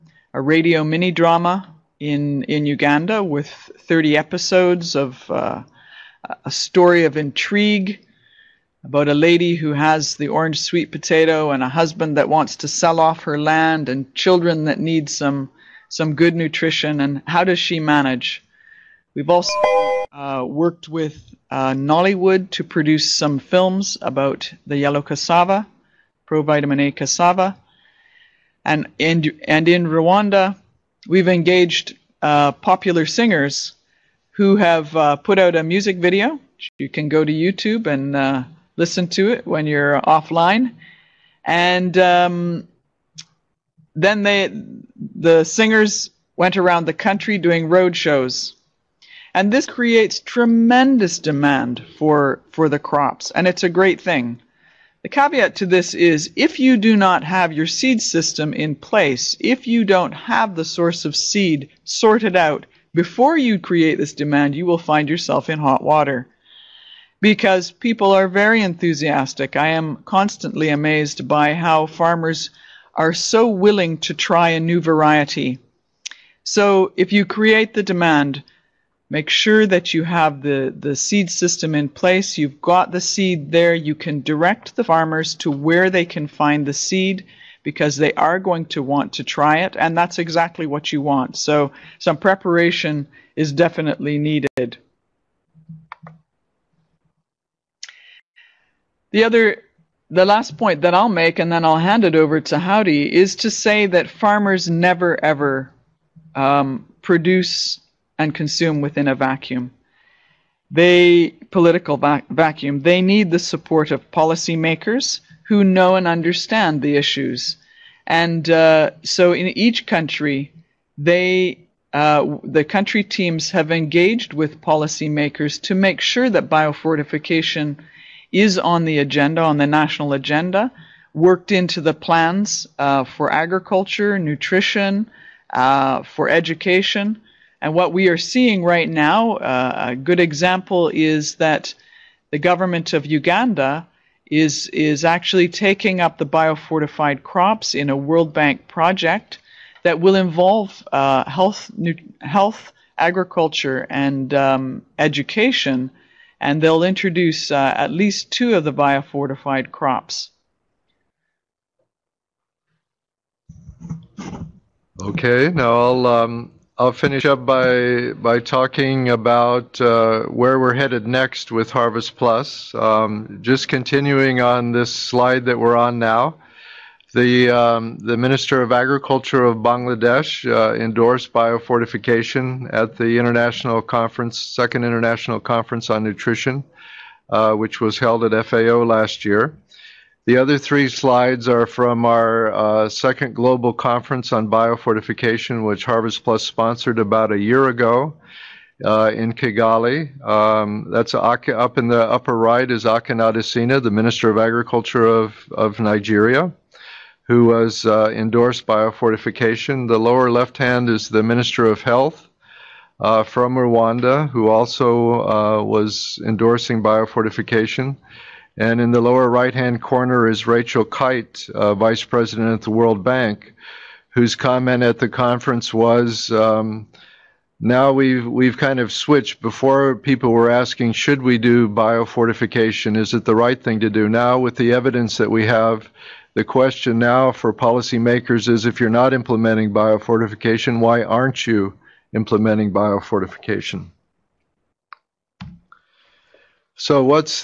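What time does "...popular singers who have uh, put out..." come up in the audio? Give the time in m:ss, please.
0:32.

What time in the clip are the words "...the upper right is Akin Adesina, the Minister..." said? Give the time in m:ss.
3:21.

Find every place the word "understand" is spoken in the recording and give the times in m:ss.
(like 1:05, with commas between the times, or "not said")
1:56.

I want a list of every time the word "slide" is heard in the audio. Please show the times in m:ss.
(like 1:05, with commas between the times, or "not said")
2:54, 3:10.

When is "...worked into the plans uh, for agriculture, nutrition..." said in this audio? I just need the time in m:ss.
2:11.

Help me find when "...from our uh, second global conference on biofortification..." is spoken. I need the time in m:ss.
3:11.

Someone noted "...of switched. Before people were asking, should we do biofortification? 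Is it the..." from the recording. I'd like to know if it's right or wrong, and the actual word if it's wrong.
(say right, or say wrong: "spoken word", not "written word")
right.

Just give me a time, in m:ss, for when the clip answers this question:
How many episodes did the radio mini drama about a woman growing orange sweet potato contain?
0:03.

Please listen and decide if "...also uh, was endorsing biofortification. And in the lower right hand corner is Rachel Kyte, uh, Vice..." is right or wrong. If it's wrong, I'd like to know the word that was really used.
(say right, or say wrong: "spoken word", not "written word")
right.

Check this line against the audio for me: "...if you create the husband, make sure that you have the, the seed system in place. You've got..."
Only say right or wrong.
wrong.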